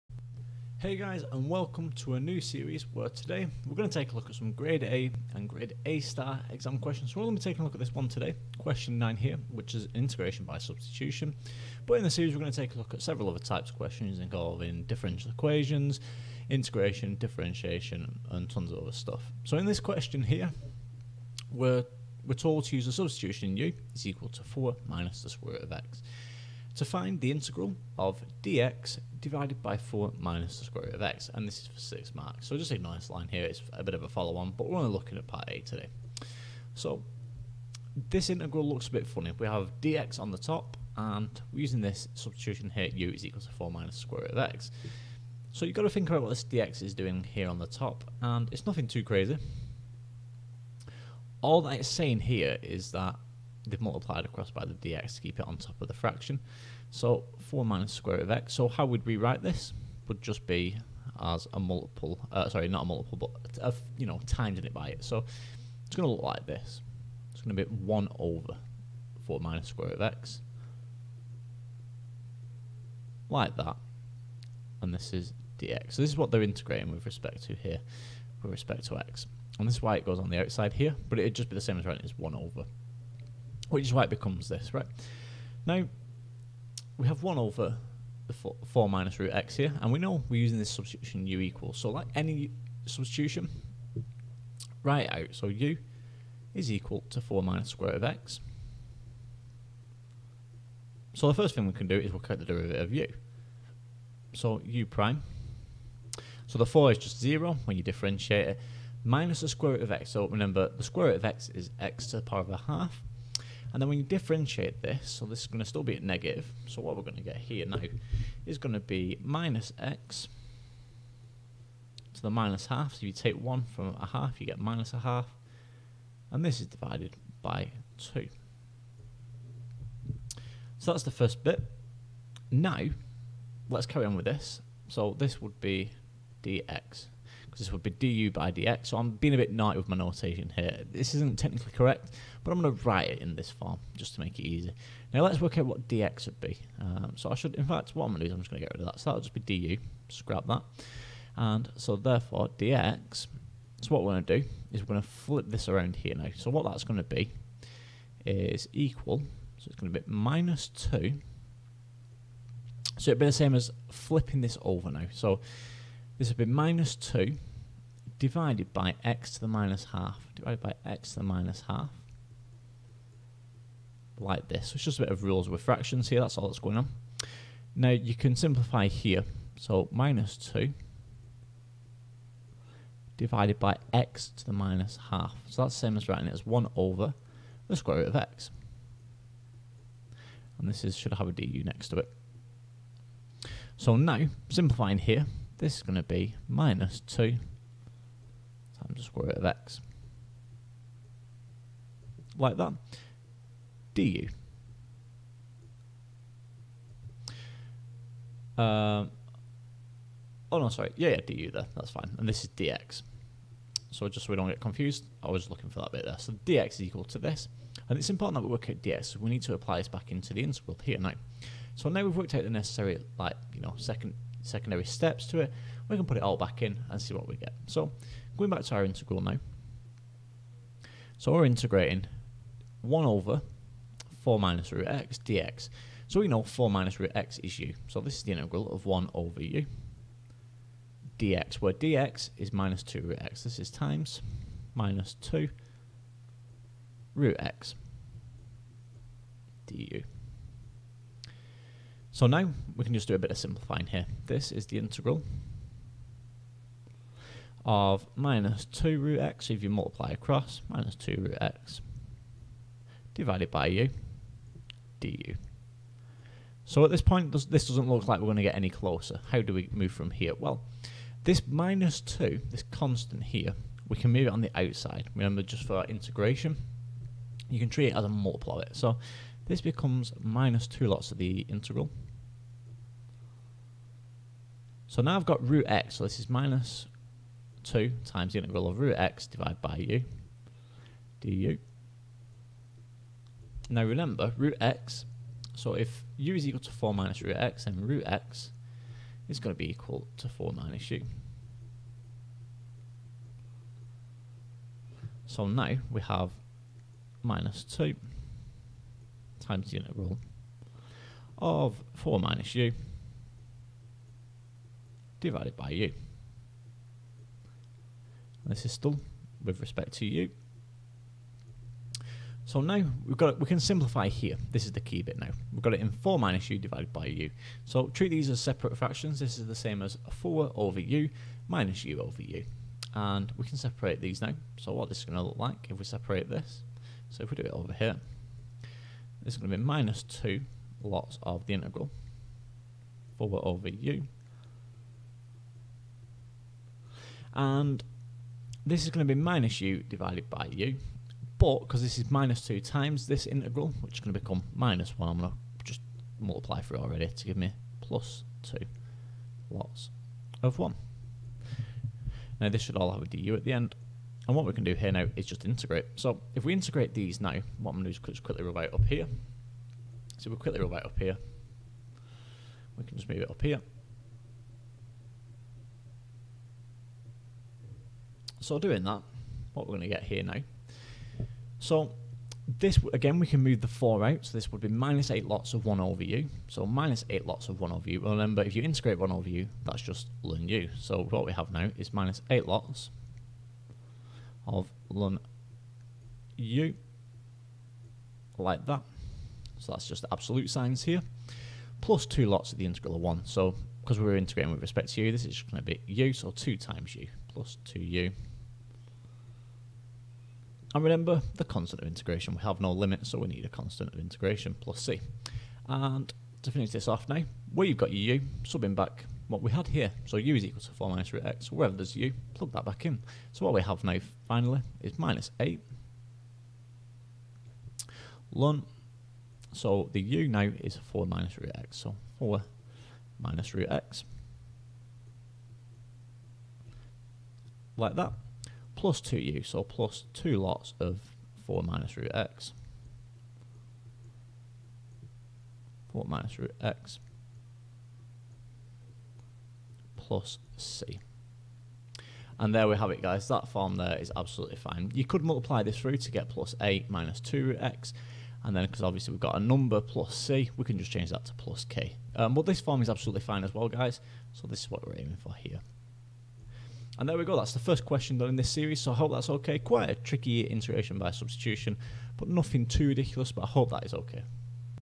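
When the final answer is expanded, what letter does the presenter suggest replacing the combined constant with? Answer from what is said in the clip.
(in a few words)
k.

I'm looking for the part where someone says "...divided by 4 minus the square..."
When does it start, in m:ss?
0:29.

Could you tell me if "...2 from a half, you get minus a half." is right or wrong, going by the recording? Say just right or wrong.
wrong.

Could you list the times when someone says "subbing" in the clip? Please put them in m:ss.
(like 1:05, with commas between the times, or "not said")
6:58.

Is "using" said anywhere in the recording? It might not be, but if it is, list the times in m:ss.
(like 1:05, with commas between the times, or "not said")
0:41, 1:30.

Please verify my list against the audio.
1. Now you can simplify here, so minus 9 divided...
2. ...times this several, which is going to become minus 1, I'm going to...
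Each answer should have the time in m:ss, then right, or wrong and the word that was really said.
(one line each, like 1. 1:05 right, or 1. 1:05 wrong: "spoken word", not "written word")
1. 2:57 wrong: "2", not "9"
2. 5:52 wrong: "integral", not "several".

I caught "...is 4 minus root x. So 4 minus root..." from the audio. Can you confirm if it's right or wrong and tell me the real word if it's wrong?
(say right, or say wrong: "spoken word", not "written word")
right.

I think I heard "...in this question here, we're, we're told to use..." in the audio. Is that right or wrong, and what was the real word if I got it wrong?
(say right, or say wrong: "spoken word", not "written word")
right.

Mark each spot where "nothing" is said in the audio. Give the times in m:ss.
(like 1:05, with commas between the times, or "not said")
0:48, 7:52.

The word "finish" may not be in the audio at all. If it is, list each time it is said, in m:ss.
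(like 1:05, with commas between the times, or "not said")
6:56.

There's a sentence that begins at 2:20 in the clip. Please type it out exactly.
This isn't technically correct, but I'm going to write it in this form just to make it easy.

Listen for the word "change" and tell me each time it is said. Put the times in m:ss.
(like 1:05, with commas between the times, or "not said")
7:40.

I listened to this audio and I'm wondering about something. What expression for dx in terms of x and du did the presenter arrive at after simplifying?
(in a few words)
minus 2 root x du.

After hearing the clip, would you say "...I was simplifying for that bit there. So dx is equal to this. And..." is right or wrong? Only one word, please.
wrong.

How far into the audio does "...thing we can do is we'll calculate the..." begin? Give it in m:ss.
1:41.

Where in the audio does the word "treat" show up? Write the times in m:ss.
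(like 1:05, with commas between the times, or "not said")
4:37, 5:27.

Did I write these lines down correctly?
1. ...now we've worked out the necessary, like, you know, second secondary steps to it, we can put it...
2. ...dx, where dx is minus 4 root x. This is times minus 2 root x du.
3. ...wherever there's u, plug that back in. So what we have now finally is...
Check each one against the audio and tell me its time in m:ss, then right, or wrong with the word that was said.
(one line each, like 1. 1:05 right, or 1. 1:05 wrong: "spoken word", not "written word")
1. 3:41 right
2. 4:01 wrong: "2", not "4"
3. 7:01 right.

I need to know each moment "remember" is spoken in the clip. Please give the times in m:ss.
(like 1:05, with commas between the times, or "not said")
1:50, 4:35, 4:53, 6:27, 6:50.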